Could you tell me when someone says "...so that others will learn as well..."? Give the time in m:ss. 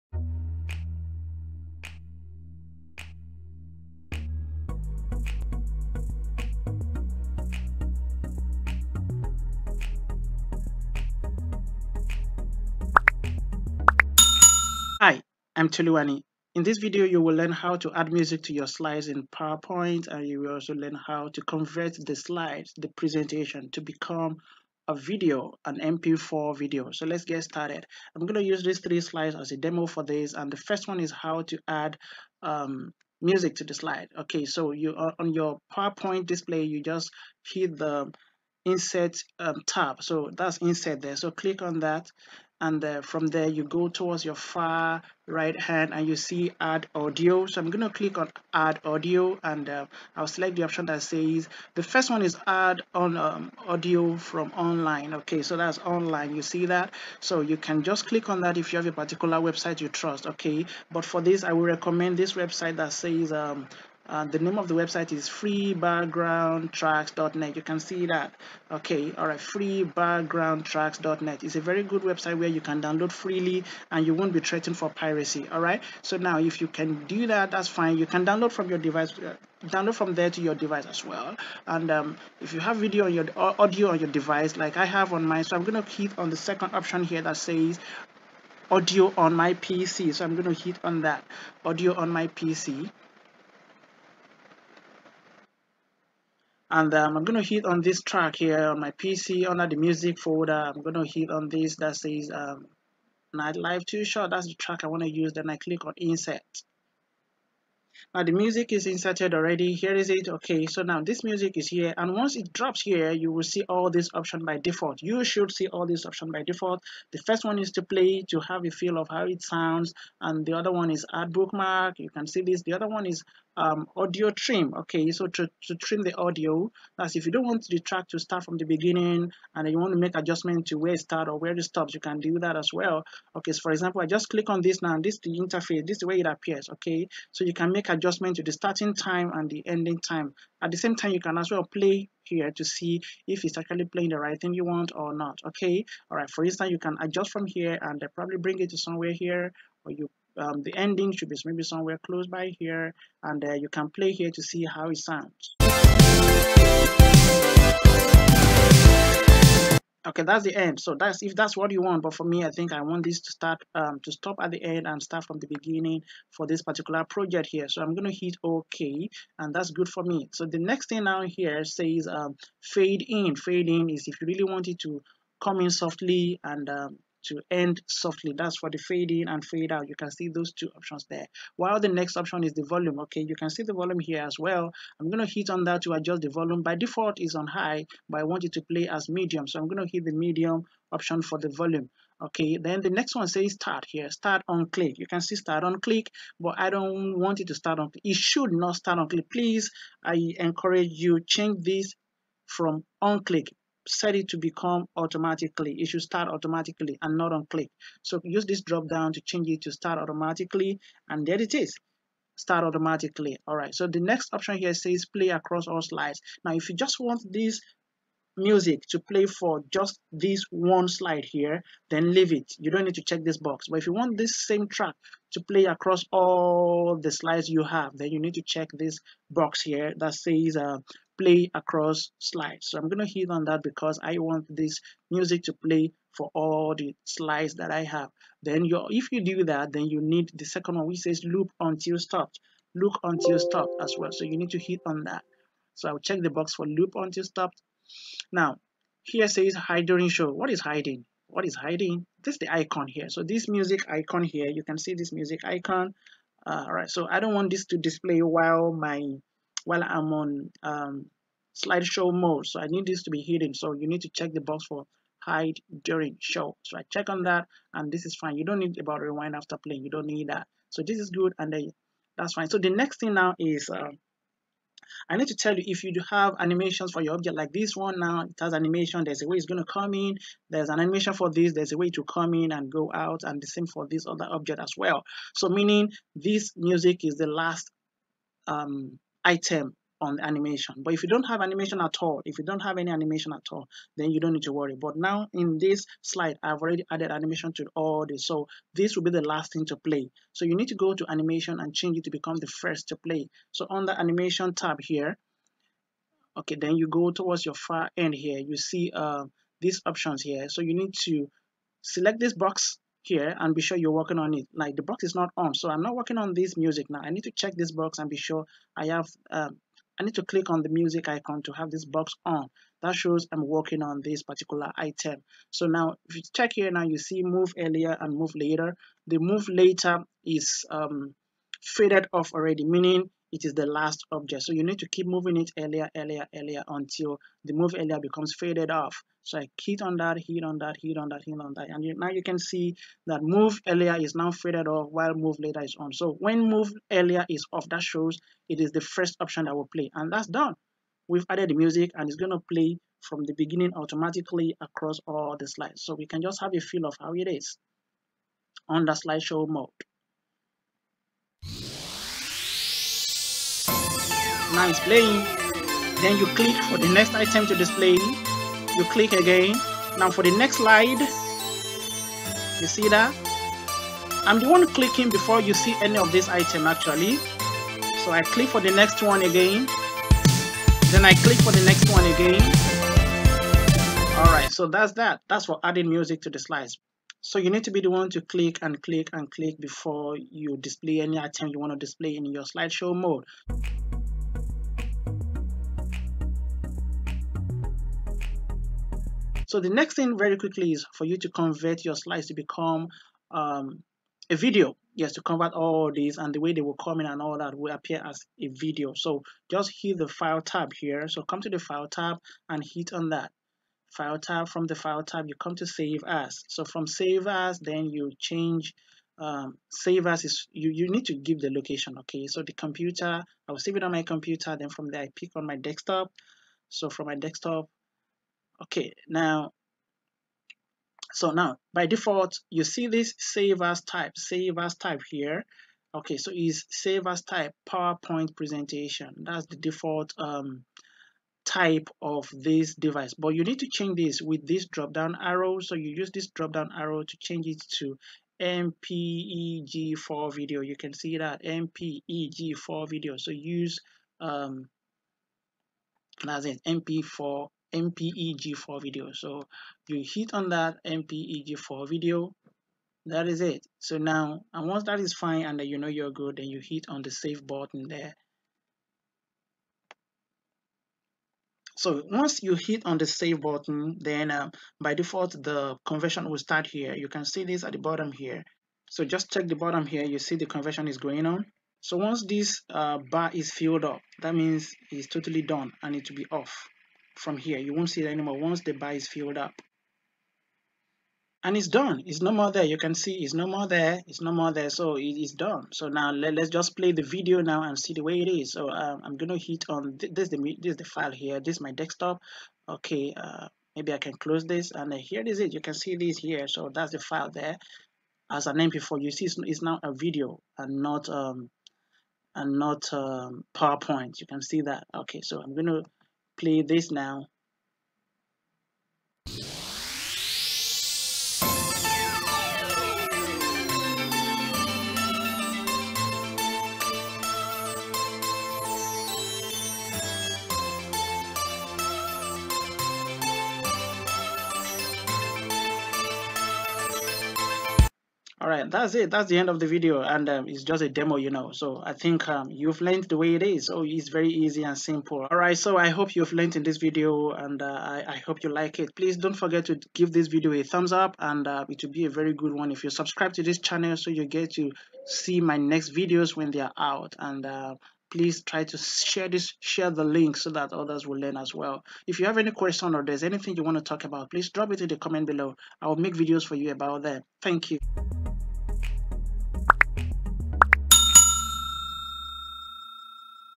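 9:20.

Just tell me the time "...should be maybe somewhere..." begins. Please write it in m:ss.
2:31.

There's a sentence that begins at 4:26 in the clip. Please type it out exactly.
So I check on that and this is fine.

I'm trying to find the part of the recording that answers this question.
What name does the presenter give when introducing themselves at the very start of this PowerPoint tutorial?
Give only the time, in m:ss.
0:15.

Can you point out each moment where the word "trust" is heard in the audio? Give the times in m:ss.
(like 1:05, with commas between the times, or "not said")
0:59.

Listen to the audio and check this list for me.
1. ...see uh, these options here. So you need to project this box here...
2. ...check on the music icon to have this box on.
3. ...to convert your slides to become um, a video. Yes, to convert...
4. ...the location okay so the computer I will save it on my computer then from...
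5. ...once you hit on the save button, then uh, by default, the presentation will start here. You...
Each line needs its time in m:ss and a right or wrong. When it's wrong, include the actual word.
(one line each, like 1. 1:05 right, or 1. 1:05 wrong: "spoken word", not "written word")
1. 5:08 wrong: "select", not "project"
2. 5:20 wrong: "click", not "check"
3. 6:41 right
4. 7:01 right
5. 7:52 wrong: "conversion", not "presentation".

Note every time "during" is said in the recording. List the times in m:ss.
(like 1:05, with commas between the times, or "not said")
4:09, 4:25.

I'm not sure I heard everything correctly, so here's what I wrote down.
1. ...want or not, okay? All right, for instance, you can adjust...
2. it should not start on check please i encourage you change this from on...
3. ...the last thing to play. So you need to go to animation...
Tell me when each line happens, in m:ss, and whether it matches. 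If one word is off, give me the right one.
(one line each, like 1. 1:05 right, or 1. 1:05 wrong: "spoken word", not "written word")
1. 2:24 right
2. 3:18 wrong: "click", not "check"
3. 4:59 right.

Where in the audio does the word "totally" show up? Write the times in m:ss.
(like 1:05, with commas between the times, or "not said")
8:05.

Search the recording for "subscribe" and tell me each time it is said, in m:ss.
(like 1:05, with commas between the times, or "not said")
9:12.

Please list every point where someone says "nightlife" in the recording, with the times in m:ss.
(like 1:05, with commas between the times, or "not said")
1:43.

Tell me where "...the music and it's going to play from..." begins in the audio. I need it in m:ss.
5:51.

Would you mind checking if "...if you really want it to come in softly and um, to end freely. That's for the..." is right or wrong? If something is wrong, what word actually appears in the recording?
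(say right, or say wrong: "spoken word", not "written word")
wrong: "softly", not "freely".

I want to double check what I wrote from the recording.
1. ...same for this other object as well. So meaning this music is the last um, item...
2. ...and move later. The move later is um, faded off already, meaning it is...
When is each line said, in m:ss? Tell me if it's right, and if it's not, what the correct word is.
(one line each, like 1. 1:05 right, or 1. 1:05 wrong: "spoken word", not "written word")
1. 4:43 right
2. 5:27 right.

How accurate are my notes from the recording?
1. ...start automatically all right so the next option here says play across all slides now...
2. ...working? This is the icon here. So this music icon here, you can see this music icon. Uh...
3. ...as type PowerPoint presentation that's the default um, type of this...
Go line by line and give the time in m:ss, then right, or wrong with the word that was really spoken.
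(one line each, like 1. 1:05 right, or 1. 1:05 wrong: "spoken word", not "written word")
1. 3:32 right
2. 4:11 wrong: "hiding", not "working"
3. 7:17 right.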